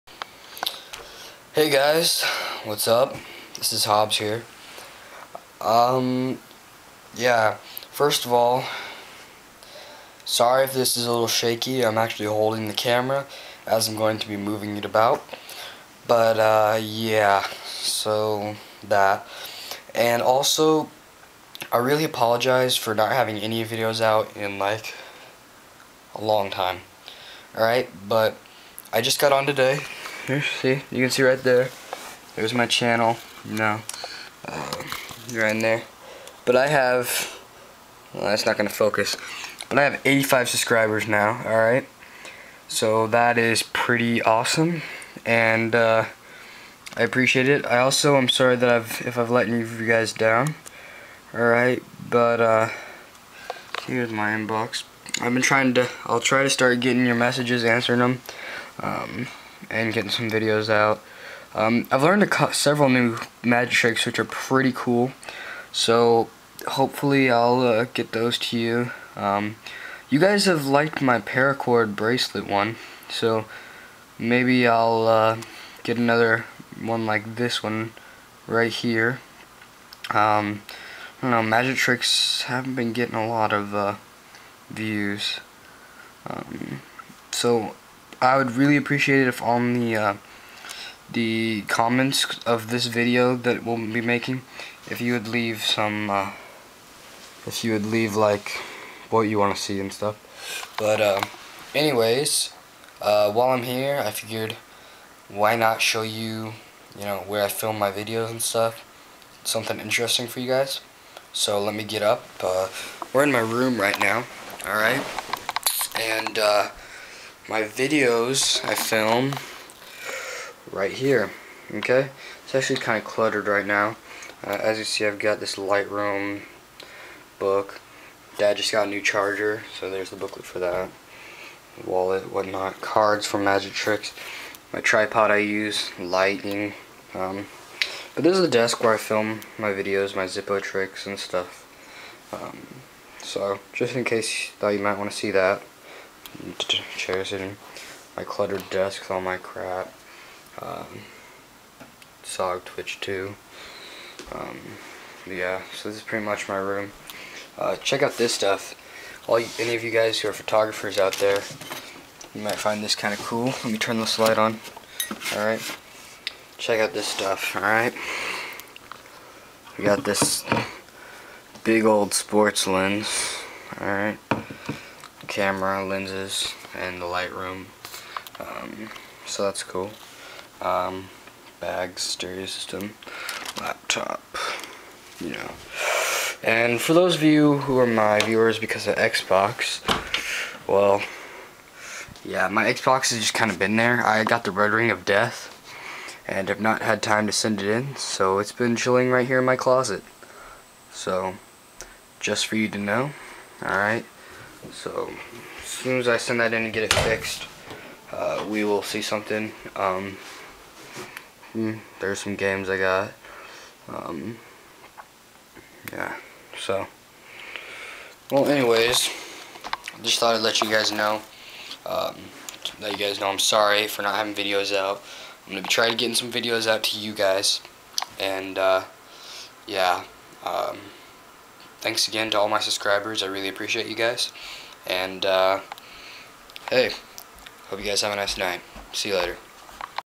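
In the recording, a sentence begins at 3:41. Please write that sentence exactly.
Um, let you guys know I'm sorry for not having videos out.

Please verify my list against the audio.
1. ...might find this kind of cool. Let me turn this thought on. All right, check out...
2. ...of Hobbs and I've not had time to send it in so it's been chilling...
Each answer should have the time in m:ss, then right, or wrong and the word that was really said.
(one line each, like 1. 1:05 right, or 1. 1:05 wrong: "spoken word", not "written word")
1. 2:42 wrong: "light", not "thought"
2. 3:14 wrong: "Death", not "Hobbs".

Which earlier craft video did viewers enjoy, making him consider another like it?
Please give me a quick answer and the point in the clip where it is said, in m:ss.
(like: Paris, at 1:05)
Paracord bracelet, at 1:11.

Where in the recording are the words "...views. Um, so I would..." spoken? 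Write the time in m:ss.
1:24.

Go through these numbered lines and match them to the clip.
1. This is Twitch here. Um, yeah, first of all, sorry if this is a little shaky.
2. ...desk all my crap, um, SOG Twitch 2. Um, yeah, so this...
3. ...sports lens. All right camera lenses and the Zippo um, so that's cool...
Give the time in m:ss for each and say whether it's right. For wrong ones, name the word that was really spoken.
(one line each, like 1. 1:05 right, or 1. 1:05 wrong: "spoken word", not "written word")
1. 0:03 wrong: "Hobbs", not "Twitch"
2. 2:28 right
3. 2:52 wrong: "Lightroom", not "Zippo".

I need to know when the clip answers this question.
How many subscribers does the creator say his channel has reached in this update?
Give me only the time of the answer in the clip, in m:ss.
0:40.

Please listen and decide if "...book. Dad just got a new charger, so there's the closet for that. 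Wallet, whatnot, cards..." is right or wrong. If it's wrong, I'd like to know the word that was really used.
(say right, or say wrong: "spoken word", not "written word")
wrong: "booklet", not "closet".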